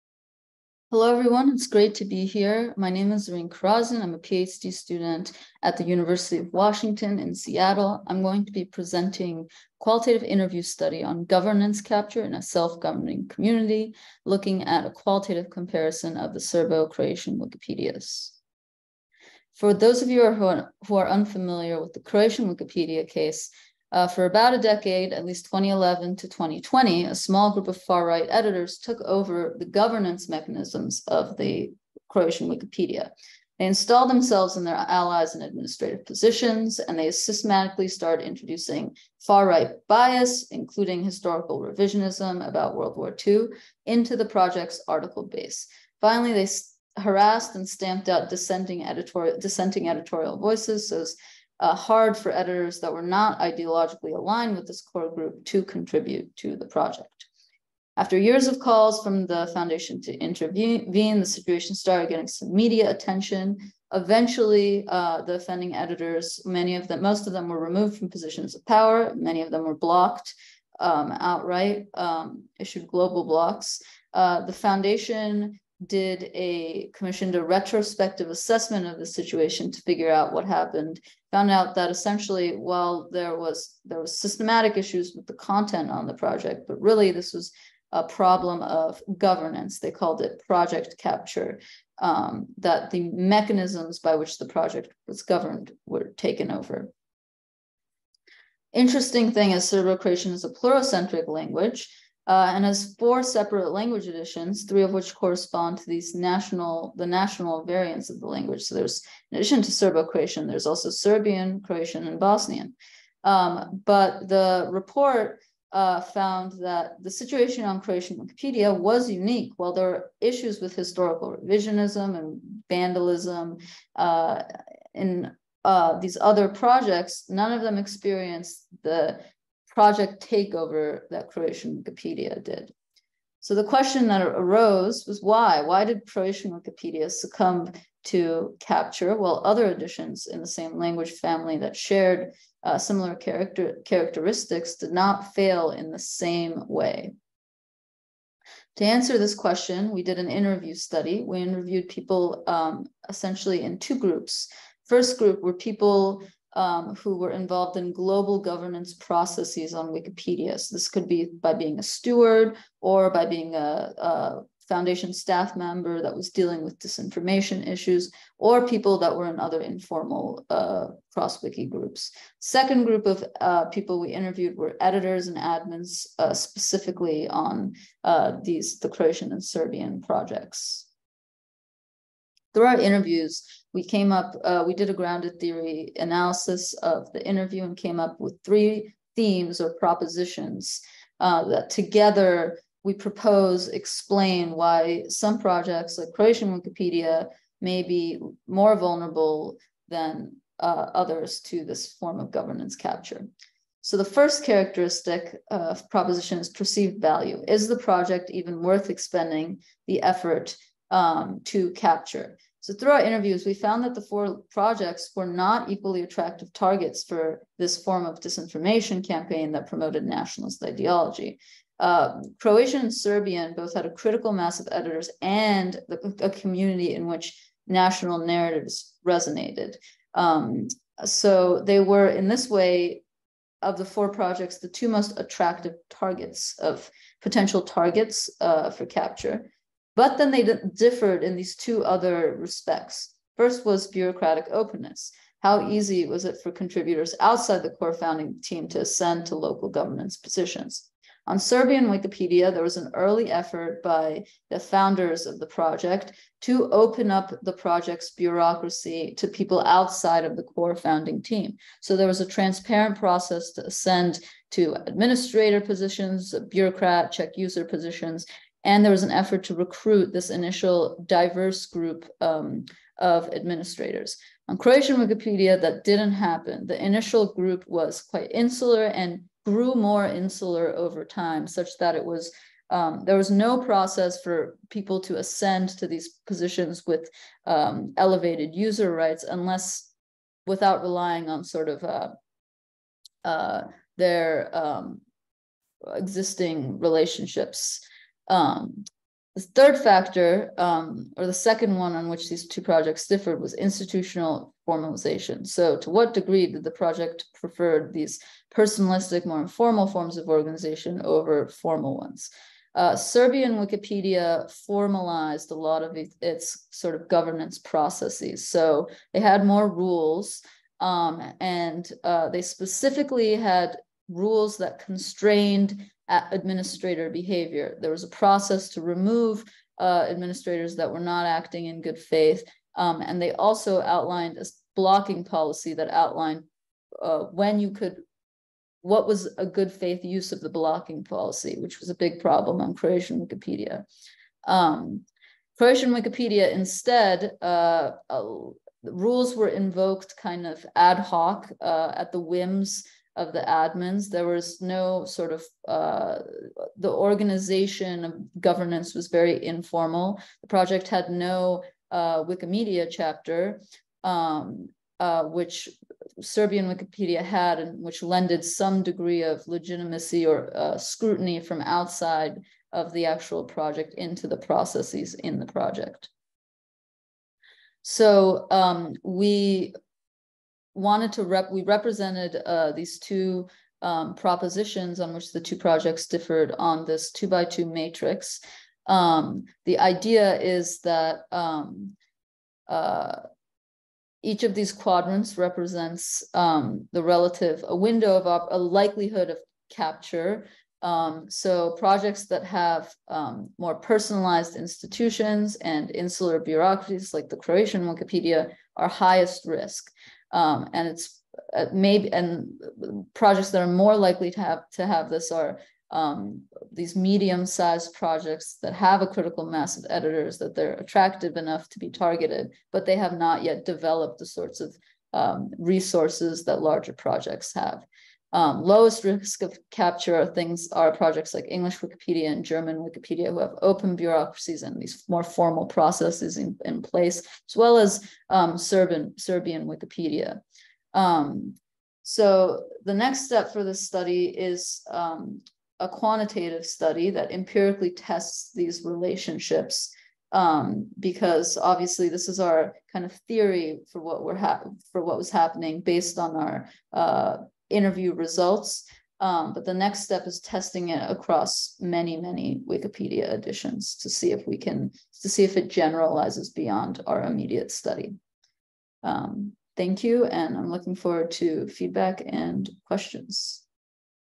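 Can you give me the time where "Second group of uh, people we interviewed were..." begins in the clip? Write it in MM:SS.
02:52.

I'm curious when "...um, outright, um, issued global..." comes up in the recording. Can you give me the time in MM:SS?
01:10.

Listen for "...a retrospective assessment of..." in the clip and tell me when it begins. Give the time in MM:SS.
01:17.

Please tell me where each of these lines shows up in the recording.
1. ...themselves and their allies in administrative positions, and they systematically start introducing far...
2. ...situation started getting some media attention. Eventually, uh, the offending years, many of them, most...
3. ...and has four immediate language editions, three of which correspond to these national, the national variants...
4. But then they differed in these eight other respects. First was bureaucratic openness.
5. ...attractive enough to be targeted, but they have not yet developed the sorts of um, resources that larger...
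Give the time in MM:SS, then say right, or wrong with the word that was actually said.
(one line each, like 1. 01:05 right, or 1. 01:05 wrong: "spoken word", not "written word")
1. 00:34 right
2. 01:01 wrong: "editors", not "years"
3. 01:42 wrong: "separate", not "immediate"
4. 03:59 wrong: "two", not "eight"
5. 07:00 right.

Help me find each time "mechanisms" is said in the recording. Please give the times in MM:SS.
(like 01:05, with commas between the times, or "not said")
00:30, 01:33.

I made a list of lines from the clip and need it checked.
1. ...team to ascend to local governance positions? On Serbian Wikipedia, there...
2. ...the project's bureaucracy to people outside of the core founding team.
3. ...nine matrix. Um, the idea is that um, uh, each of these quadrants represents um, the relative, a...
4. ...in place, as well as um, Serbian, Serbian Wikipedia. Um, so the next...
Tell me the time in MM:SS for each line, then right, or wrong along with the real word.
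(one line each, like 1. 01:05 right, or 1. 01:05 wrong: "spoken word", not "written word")
1. 04:08 right
2. 04:17 right
3. 06:27 wrong: "two", not "nine"
4. 07:16 right.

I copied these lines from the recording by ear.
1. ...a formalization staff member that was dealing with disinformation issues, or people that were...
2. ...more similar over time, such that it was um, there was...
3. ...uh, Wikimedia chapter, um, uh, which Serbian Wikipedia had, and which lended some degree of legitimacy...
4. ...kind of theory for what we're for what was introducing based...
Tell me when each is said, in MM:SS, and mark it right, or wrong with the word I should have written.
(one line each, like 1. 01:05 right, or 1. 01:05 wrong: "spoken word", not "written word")
1. 02:43 wrong: "foundation", not "formalization"
2. 04:39 wrong: "insular", not "similar"
3. 06:01 right
4. 07:32 wrong: "happening", not "introducing".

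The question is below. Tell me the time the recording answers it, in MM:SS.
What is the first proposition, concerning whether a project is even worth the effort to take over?
03:26.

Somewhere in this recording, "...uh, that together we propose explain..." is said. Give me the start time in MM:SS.
03:11.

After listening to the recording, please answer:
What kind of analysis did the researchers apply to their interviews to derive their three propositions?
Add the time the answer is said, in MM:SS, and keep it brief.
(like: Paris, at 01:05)
grounded theory, at 03:04.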